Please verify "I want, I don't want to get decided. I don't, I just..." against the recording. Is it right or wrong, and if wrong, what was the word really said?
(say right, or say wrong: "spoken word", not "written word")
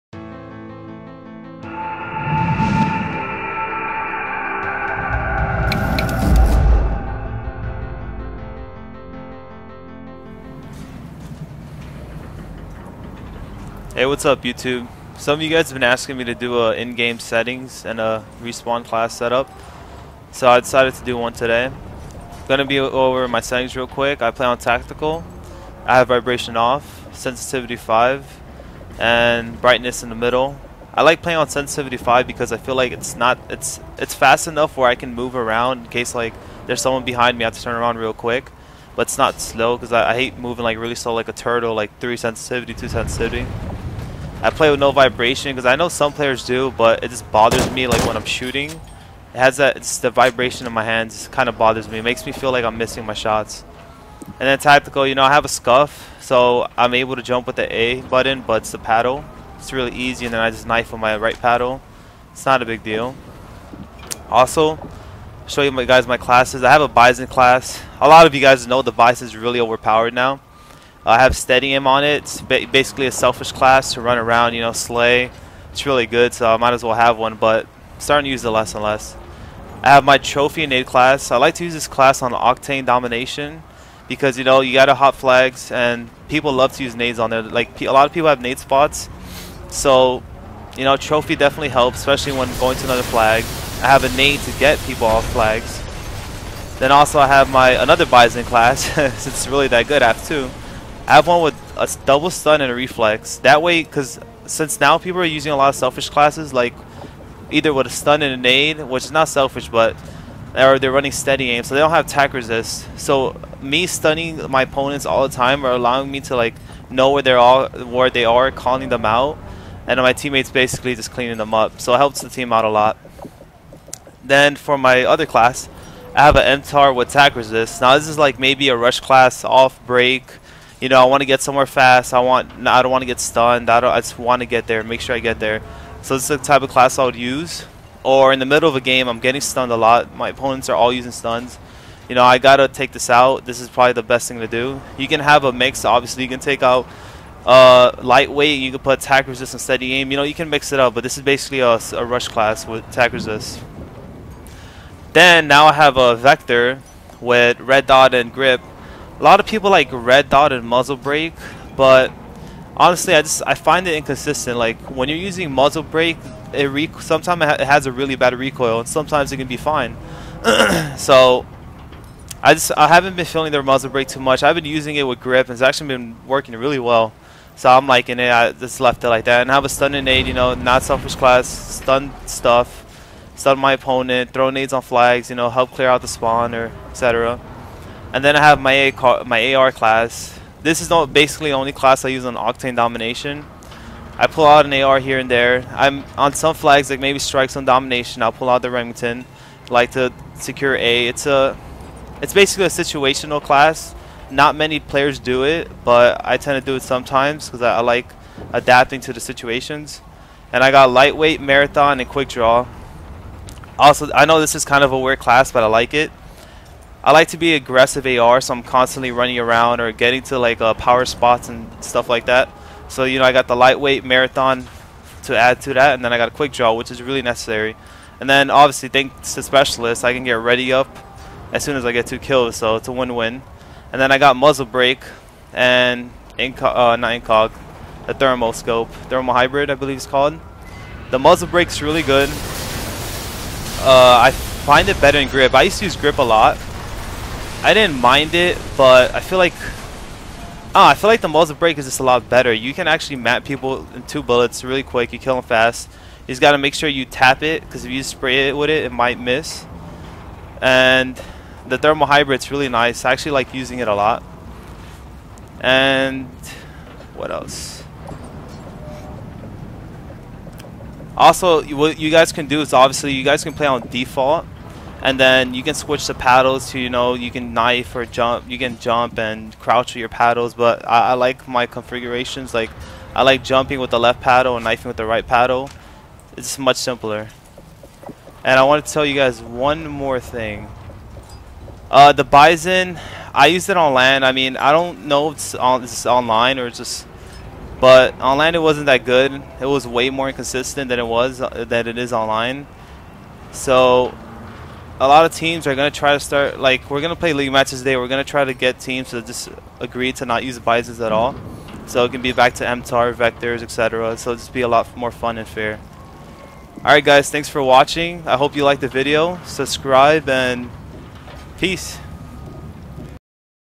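wrong: "stunned", not "decided".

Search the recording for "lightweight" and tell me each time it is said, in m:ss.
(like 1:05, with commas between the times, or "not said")
2:28, 3:30, 3:43.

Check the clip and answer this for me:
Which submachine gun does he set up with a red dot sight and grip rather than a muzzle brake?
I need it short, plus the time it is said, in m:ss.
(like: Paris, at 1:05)
Vector, at 2:36.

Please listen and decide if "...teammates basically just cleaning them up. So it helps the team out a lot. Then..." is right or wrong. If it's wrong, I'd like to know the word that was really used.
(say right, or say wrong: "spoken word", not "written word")
right.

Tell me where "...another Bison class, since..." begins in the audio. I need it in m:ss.
1:37.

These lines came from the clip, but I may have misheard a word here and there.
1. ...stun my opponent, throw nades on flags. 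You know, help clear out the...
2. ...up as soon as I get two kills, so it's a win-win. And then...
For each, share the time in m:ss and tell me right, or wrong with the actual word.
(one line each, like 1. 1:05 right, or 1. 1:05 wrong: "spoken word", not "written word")
1. 3:03 right
2. 3:50 right.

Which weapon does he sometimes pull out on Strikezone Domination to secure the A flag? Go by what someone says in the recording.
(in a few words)
Remington.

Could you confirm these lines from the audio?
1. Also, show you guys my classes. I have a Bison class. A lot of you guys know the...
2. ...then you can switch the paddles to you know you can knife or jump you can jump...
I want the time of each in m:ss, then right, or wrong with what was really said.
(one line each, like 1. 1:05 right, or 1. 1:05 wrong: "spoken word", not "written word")
1. 1:04 right
2. 4:35 right.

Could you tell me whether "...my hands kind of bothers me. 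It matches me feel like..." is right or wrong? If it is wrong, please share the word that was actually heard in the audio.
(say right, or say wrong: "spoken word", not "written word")
wrong: "makes", not "matches".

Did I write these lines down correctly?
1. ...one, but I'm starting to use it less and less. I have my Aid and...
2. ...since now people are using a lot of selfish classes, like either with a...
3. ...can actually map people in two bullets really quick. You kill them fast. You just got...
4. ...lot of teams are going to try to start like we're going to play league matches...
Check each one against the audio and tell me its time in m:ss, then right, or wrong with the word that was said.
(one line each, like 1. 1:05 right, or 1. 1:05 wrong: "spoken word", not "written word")
1. 1:17 wrong: "Trophy", not "Aid"
2. 1:44 right
3. 4:12 right
4. 5:05 right.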